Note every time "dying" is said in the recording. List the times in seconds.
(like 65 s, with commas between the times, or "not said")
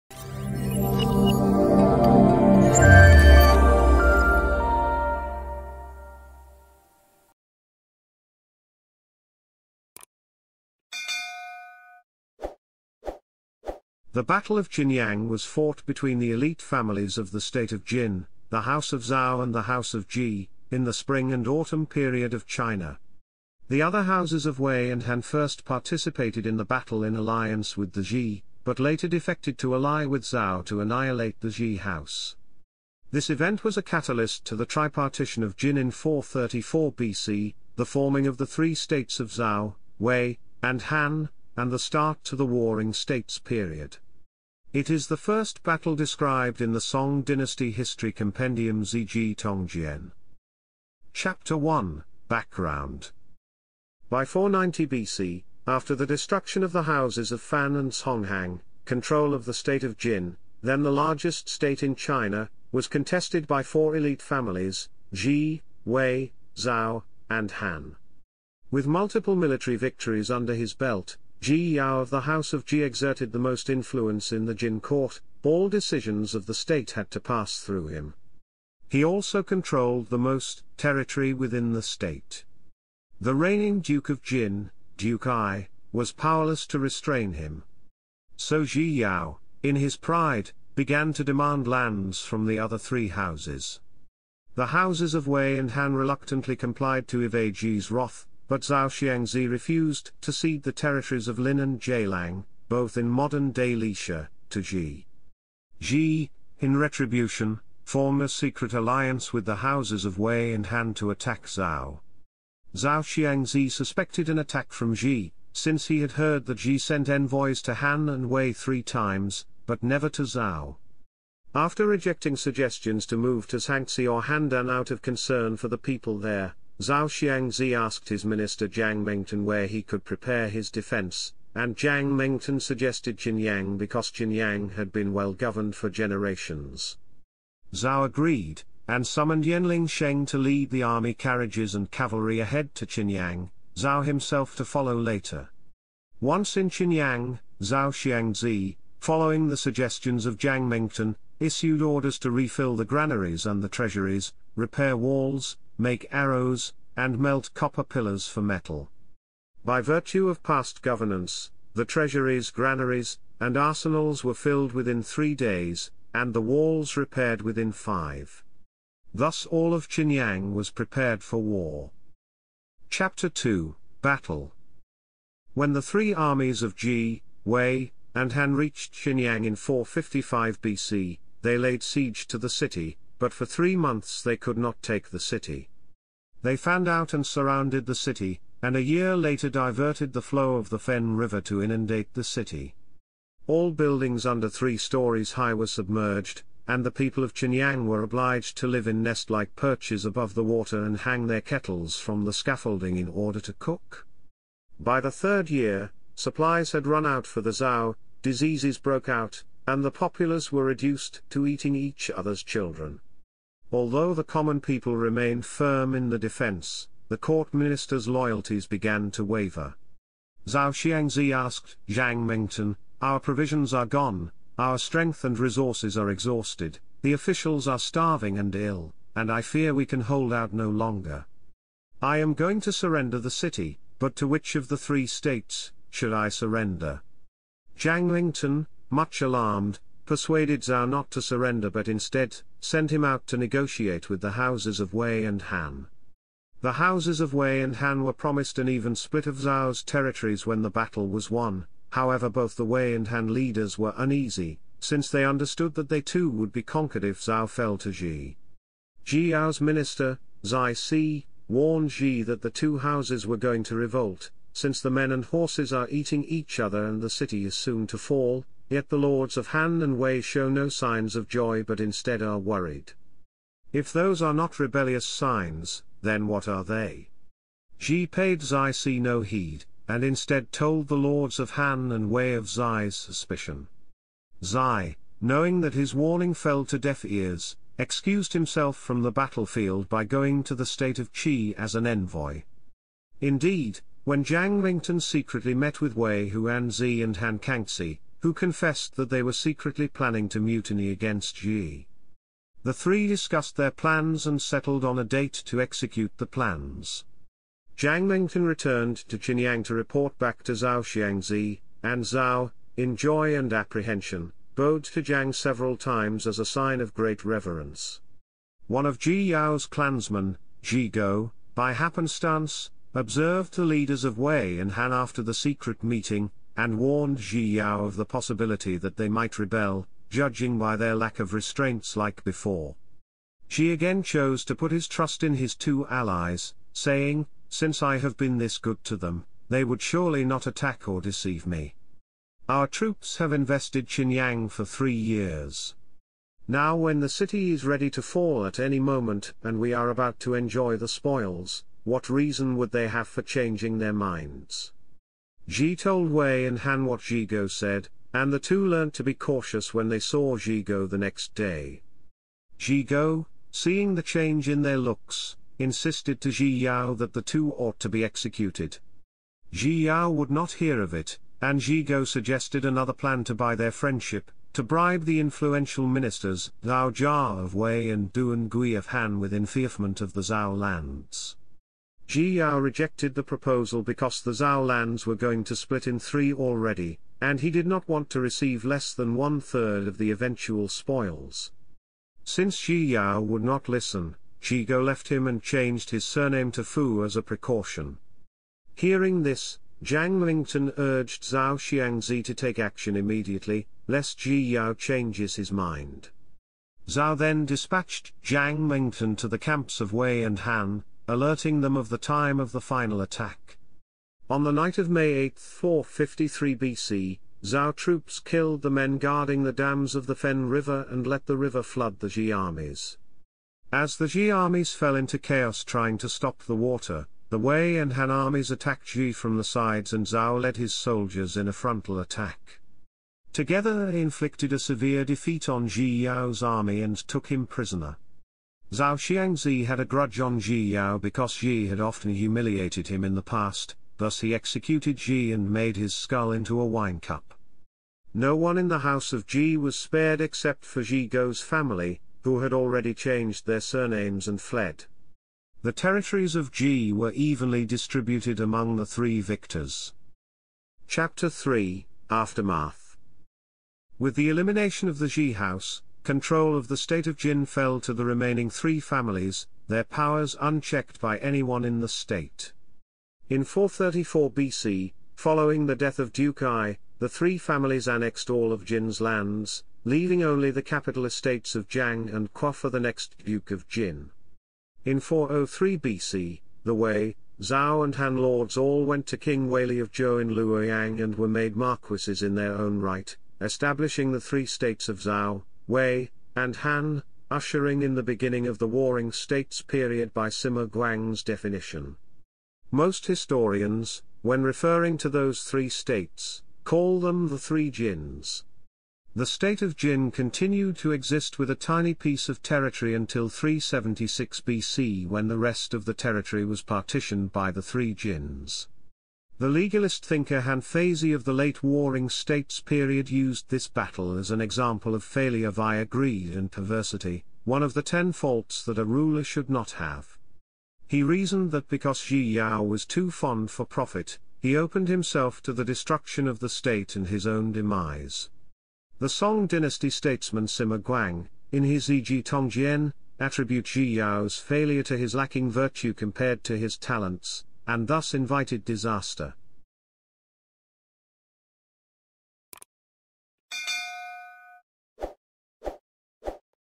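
not said.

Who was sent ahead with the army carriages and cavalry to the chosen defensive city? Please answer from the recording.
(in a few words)
Yenling Sheng.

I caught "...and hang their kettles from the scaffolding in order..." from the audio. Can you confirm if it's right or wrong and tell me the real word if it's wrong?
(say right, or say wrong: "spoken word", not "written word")
right.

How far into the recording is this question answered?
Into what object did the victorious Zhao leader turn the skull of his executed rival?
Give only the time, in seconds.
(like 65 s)
446 s.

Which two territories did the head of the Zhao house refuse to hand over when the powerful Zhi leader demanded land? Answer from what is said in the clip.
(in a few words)
Lin and Jilang.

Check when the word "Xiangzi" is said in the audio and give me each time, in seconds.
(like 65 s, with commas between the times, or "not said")
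98 s, 113 s, 127 s, 147 s, 220 s, 310 s, 401 s, 438 s.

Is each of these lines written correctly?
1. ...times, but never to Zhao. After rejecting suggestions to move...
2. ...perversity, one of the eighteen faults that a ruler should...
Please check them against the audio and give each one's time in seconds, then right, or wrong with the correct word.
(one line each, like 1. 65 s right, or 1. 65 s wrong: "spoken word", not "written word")
1. 118 s right
2. 526 s wrong: "ten", not "eighteen".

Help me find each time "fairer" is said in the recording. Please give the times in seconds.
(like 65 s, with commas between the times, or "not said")
not said.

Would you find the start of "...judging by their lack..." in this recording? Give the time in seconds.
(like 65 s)
330 s.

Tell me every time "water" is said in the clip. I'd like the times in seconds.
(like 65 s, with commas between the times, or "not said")
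200 s, 426 s.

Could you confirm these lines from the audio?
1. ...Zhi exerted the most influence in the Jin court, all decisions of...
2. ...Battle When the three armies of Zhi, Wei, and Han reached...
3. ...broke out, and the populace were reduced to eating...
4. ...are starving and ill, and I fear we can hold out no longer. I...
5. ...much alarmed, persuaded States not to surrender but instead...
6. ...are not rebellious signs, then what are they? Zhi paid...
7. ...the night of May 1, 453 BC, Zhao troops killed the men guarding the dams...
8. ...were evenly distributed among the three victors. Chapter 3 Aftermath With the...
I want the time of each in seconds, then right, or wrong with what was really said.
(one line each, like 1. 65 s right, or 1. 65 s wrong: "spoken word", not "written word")
1. 72 s right
2. 174 s right
3. 208 s right
4. 227 s right
5. 238 s wrong: "Zhao", not "States"
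6. 274 s right
7. 414 s wrong: "8", not "1"
8. 456 s right.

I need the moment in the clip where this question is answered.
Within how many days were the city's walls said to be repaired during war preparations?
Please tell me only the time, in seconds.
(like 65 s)
167 s.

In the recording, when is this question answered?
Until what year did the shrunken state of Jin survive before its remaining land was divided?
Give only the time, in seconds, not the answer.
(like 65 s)
513 s.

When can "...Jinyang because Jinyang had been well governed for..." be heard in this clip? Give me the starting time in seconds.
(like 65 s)
133 s.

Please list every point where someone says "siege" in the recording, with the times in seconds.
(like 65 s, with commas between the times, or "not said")
181 s.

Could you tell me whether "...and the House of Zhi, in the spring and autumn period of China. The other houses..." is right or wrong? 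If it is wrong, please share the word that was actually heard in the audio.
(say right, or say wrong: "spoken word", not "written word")
right.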